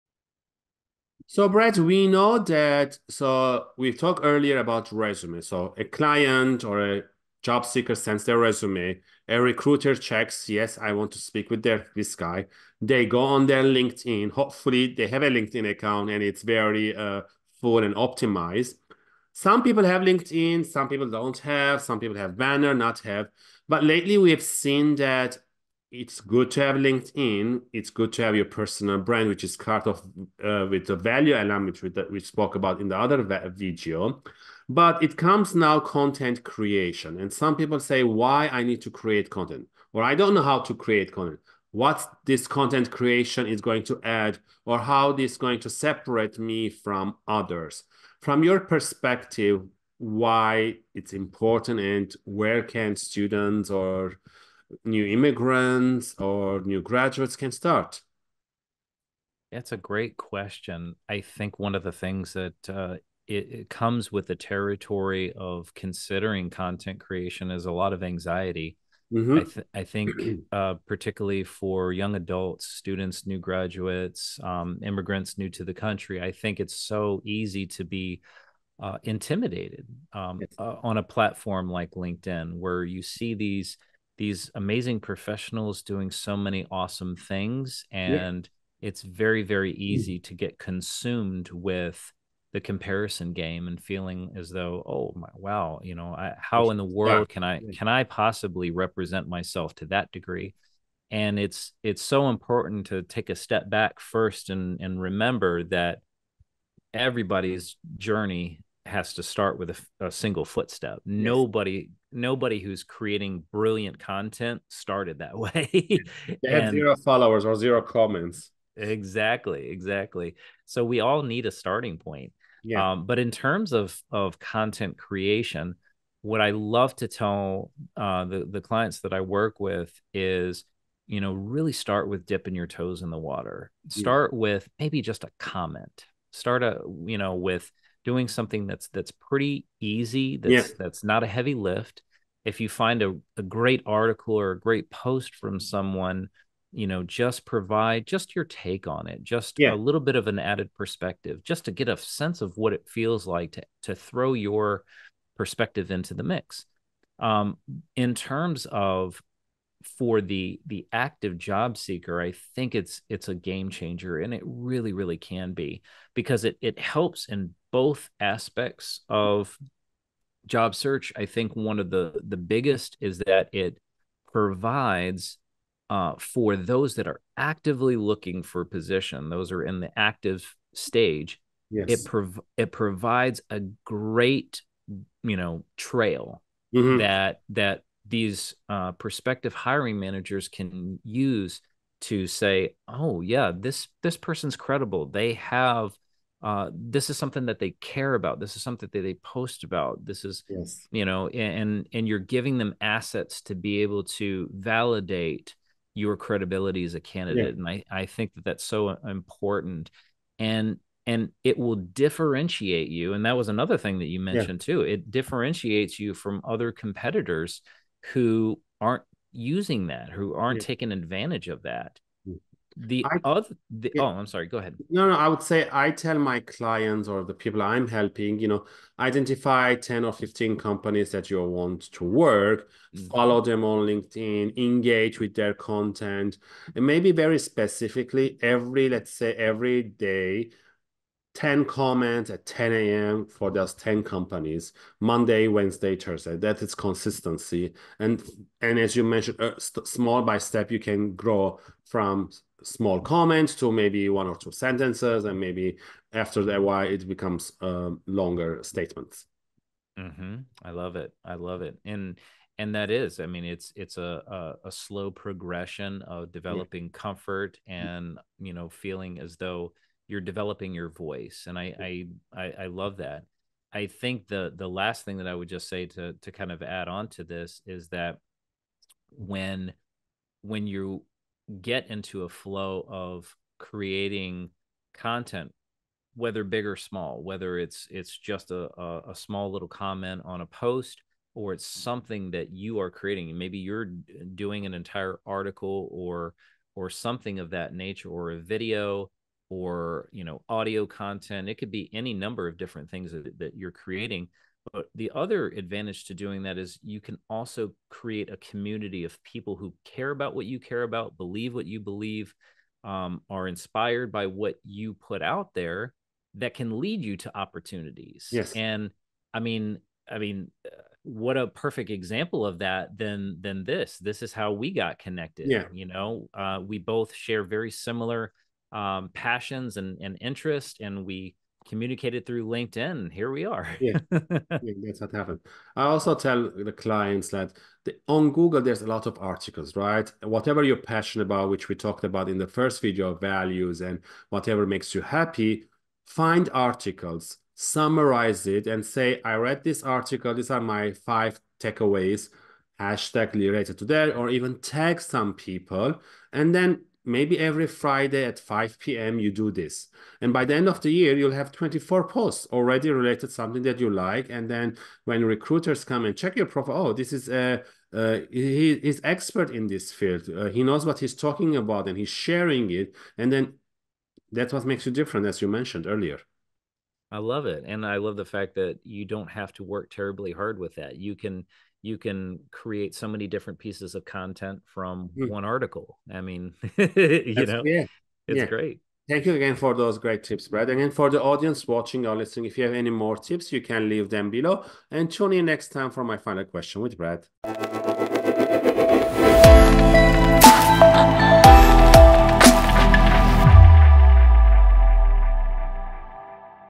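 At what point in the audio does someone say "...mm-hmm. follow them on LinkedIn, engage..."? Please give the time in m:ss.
3:52.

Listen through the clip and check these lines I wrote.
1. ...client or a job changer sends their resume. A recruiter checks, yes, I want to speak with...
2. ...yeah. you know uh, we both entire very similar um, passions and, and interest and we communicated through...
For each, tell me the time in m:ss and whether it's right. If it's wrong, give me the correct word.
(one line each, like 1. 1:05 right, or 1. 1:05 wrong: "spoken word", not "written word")
1. 0:05 wrong: "seeker", not "changer"
2. 5:25 wrong: "share", not "entire".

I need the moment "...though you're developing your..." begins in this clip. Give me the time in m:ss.
4:29.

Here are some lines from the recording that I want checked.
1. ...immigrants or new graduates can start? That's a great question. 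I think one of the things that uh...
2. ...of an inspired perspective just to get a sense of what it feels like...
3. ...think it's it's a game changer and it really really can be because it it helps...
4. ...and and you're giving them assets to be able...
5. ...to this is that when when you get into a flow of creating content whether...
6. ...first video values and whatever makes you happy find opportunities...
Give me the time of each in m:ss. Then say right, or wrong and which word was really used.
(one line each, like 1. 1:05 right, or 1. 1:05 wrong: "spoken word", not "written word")
1. 0:55 right
2. 2:30 wrong: "added", not "inspired"
3. 2:42 right
4. 3:21 right
5. 4:37 right
6. 5:42 wrong: "articles", not "opportunities".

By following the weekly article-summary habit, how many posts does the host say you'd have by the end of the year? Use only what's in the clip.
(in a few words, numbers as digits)
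24.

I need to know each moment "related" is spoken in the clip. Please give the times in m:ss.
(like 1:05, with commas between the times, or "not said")
5:53, 6:02.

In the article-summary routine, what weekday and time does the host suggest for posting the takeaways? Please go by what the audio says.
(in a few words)
Friday at 5 p.m.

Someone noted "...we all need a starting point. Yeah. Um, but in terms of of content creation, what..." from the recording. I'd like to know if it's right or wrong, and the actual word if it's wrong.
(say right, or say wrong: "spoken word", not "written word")
right.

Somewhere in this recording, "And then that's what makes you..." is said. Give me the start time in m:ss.
6:13.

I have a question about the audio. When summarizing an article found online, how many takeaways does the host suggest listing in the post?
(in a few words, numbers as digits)
5.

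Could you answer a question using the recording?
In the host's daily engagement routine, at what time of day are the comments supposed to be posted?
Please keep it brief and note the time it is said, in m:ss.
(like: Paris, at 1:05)
10 a.m., at 4:02.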